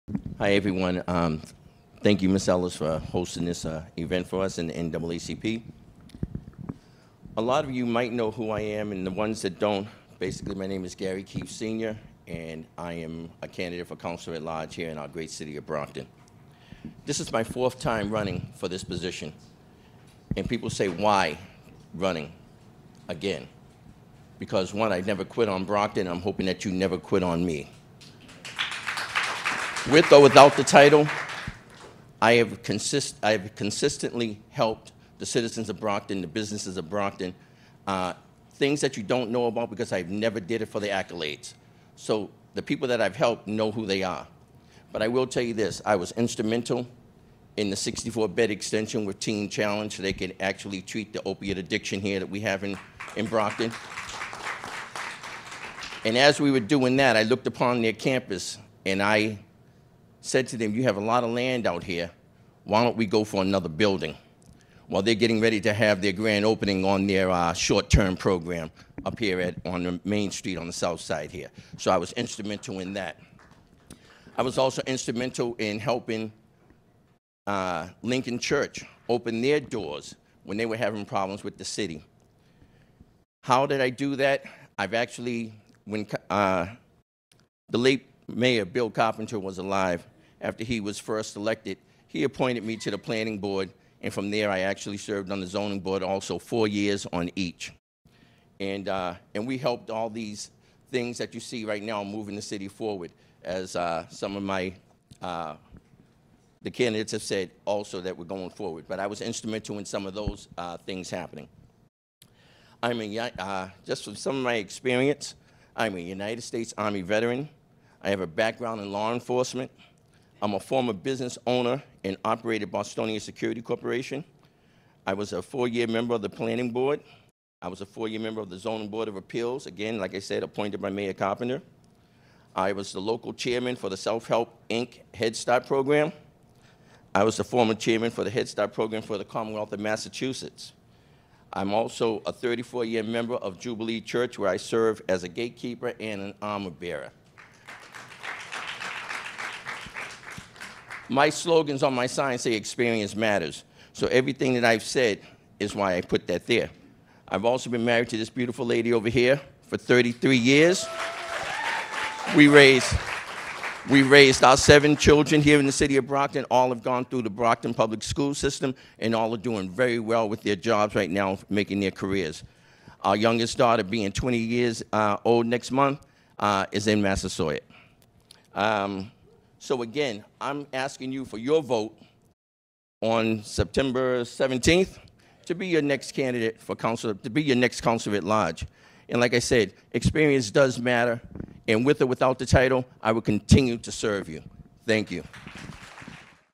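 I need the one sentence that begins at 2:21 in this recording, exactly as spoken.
I'm also a 34 year member of Jubilee Church, where I serve as a gatekeeper and an armor bearer.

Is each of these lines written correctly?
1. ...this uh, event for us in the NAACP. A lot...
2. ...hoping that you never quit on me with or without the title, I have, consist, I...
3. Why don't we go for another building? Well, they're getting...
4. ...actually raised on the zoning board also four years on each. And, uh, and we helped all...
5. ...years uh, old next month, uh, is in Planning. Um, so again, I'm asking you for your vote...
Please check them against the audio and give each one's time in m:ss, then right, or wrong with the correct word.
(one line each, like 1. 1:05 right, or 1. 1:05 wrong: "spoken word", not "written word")
1. 0:03 right
2. 0:26 right
3. 1:02 right
4. 1:34 wrong: "served", not "raised"
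5. 2:54 wrong: "Massasoit", not "Planning".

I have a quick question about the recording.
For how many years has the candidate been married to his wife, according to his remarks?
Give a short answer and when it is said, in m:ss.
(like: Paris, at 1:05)
33, at 2:39.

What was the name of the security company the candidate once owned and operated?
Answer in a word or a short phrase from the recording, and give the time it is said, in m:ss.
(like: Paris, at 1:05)
Bostonian Security Corporation, at 2:02.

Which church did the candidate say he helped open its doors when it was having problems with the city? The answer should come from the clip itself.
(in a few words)
Lincoln Church.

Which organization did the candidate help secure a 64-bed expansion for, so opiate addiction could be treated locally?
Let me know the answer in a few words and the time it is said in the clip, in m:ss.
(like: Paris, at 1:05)
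Teen Challenge, at 0:49.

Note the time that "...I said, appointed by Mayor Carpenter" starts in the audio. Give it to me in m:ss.
2:10.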